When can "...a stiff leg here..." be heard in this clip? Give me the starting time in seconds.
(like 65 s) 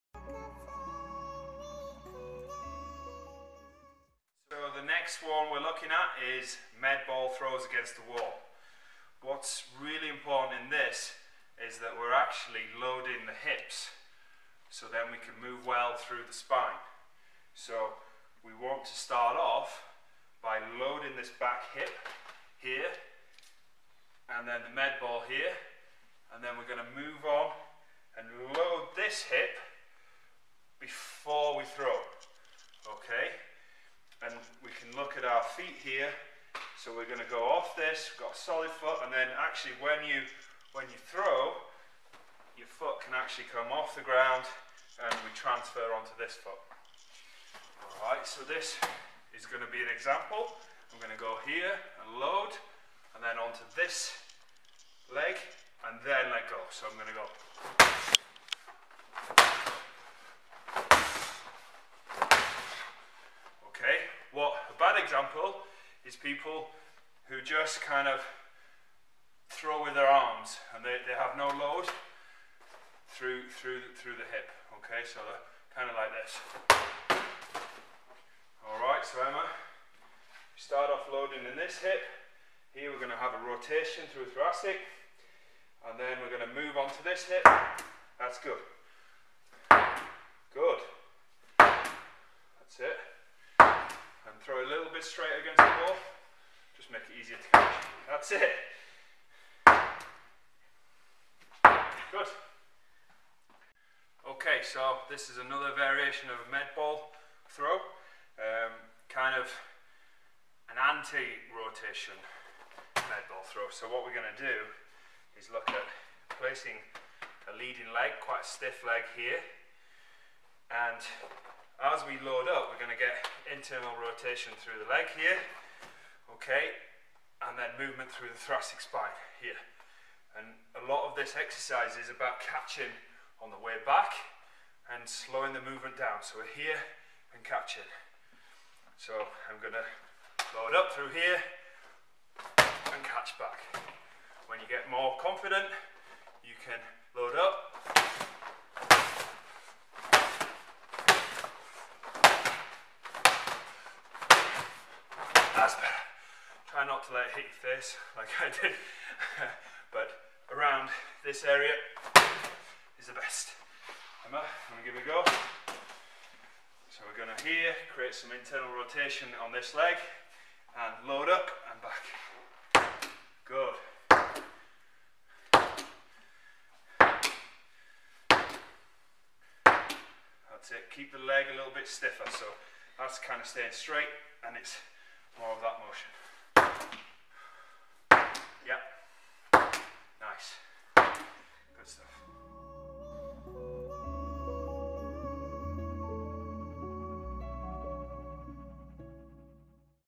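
118 s.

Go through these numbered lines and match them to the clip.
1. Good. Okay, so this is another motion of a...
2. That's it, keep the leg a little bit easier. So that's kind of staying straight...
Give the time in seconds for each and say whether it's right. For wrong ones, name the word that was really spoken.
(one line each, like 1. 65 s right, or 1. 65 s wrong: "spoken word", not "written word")
1. 102 s wrong: "variation", not "motion"
2. 174 s wrong: "stiffer", not "easier".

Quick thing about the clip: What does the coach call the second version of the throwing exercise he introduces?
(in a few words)
Anti-rotation med ball throw.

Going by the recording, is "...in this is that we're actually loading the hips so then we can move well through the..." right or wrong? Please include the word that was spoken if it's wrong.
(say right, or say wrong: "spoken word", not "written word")
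right.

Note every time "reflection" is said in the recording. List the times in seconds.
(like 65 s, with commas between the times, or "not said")
not said.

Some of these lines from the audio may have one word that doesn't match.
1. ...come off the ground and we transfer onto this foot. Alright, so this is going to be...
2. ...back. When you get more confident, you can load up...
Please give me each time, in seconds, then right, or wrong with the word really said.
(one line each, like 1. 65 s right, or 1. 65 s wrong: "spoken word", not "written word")
1. 43 s right
2. 143 s right.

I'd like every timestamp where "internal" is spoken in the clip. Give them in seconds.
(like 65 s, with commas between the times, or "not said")
123 s, 168 s.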